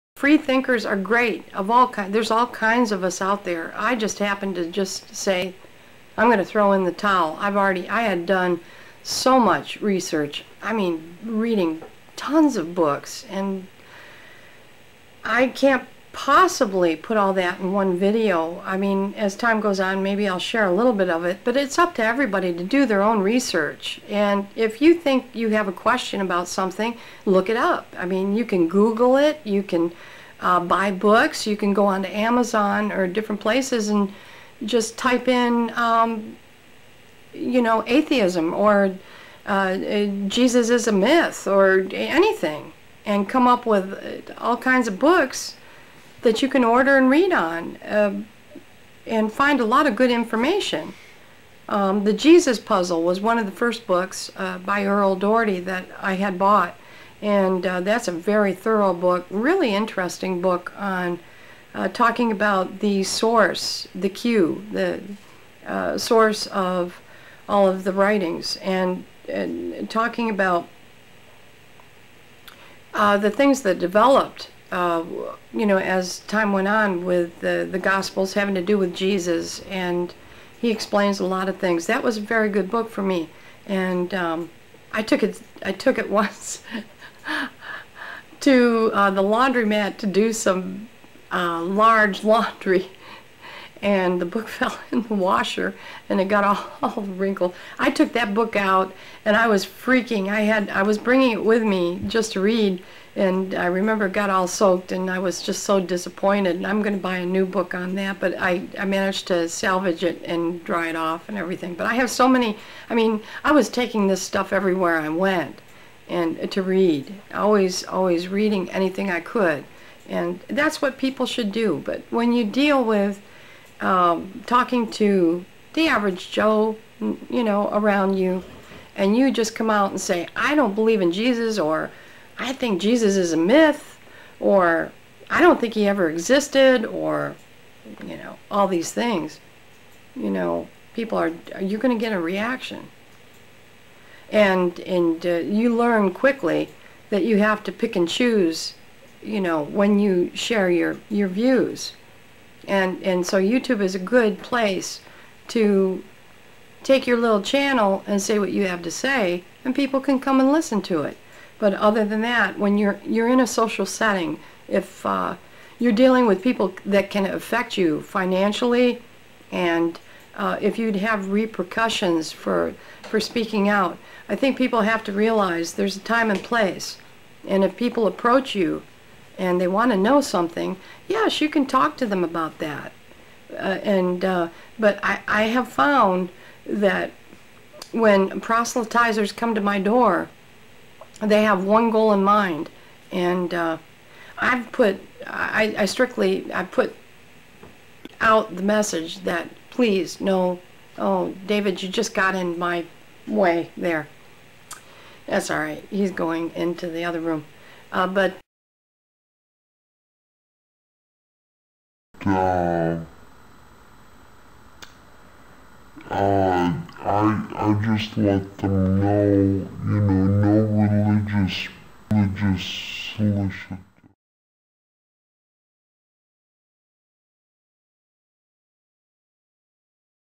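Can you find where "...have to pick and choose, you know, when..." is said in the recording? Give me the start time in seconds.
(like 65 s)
147 s.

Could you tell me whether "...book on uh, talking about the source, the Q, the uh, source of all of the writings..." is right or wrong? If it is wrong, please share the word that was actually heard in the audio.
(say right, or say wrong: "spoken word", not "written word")
right.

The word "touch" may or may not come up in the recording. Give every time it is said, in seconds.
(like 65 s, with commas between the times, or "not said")
not said.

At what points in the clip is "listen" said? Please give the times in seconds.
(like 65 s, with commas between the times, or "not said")
160 s.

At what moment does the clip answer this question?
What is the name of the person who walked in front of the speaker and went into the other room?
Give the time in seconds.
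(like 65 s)
201 s.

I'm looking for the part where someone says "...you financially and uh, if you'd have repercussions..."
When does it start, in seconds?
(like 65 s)
167 s.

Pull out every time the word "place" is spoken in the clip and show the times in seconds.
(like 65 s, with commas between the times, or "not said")
33 s, 154 s, 176 s.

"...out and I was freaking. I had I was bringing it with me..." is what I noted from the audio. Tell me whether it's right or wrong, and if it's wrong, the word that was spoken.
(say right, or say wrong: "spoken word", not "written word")
right.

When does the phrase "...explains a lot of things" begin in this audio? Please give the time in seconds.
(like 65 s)
80 s.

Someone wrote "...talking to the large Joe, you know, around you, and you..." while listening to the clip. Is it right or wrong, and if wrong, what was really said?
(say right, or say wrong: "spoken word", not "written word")
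wrong: "average", not "large".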